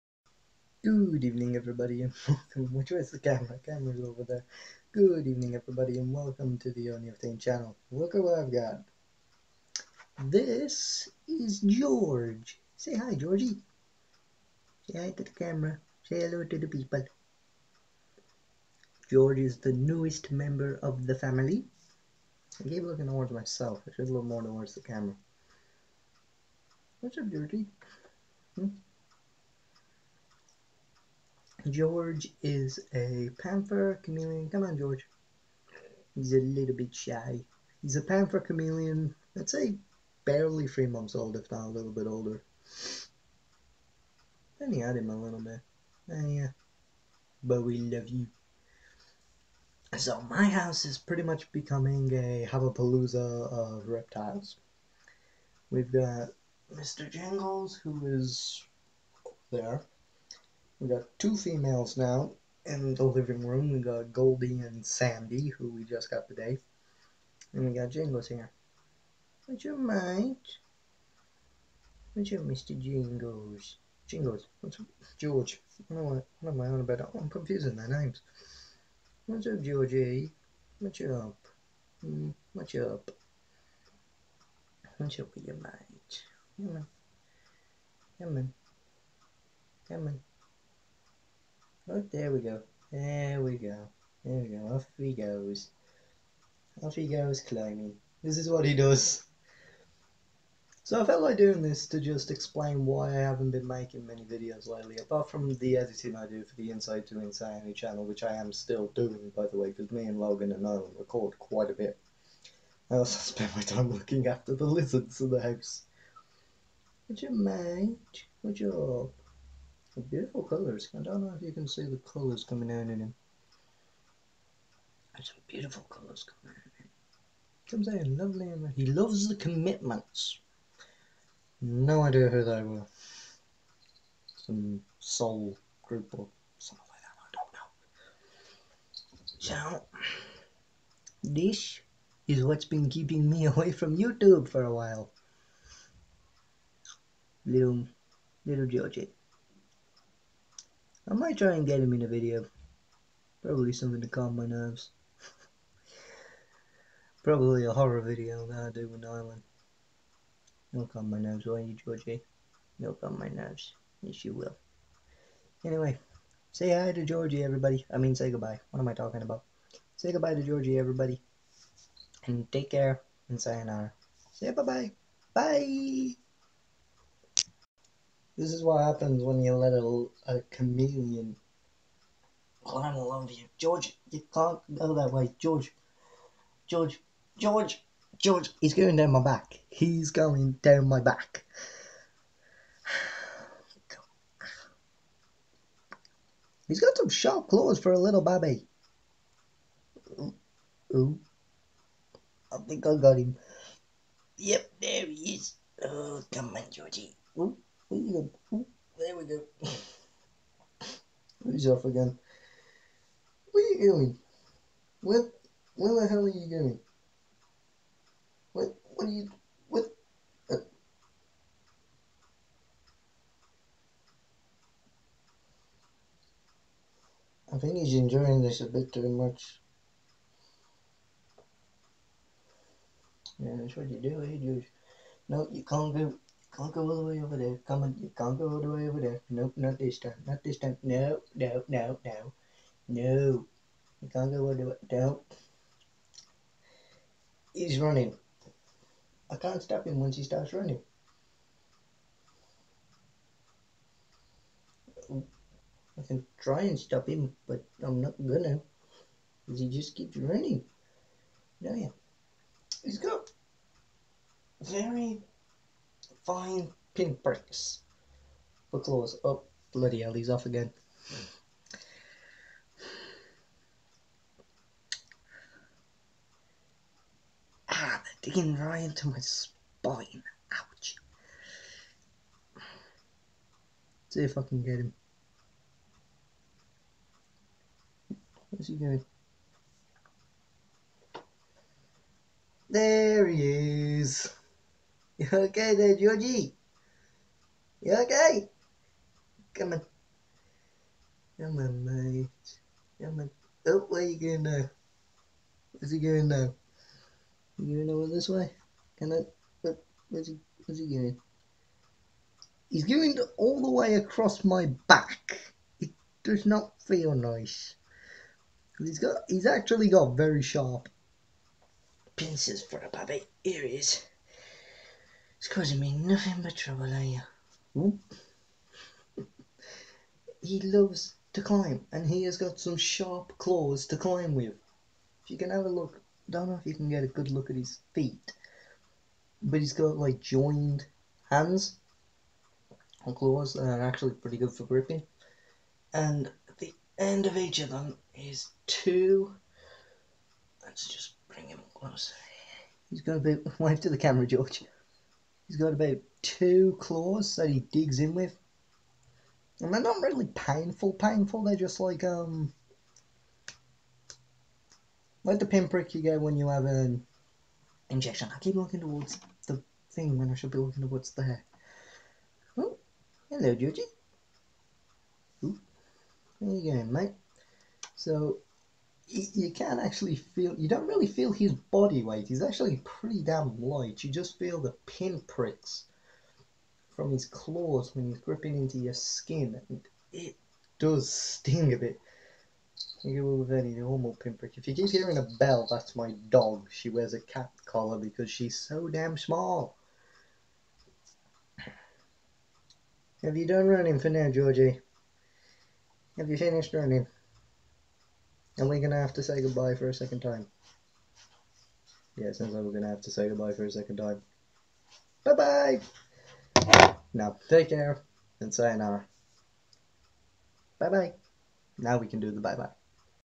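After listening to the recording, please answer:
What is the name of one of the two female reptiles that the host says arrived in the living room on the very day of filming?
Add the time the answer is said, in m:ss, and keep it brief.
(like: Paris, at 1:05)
Sandy, at 1:04.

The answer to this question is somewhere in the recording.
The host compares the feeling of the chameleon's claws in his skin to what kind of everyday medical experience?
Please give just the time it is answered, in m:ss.
6:07.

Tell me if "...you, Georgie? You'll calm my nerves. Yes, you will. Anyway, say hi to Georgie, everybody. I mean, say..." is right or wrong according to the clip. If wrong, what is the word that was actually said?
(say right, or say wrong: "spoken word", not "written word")
right.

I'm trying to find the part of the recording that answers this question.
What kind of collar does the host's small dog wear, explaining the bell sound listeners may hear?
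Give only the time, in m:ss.
6:37.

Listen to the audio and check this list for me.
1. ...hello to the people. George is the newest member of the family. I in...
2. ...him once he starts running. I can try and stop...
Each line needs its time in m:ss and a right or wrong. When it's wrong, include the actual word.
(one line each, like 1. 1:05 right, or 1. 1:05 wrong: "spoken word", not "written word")
1. 0:16 right
2. 4:09 right.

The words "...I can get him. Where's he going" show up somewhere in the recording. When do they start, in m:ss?
4:44.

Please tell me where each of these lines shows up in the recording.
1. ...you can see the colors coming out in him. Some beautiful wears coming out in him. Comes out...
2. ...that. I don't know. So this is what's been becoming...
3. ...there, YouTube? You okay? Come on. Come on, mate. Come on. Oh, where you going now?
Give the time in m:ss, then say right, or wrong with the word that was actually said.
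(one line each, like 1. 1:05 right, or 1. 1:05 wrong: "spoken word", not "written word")
1. 2:01 wrong: "colors", not "wears"
2. 2:17 wrong: "keeping", not "becoming"
3. 4:55 wrong: "Georgie", not "YouTube".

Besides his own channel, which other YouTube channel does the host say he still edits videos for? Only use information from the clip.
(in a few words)
Inside to Insanity.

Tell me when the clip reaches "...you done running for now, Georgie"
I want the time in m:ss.
6:43.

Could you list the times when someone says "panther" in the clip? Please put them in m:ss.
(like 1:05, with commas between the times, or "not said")
0:33, 0:38.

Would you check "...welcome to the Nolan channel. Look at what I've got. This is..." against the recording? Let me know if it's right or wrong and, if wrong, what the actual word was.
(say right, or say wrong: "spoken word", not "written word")
wrong: "OniOfTaint", not "Nolan".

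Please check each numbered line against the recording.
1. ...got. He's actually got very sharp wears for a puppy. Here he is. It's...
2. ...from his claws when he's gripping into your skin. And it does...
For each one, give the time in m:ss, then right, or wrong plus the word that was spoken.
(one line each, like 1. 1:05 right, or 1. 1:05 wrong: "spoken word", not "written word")
1. 5:18 wrong: "pincers", not "wears"
2. 6:26 right.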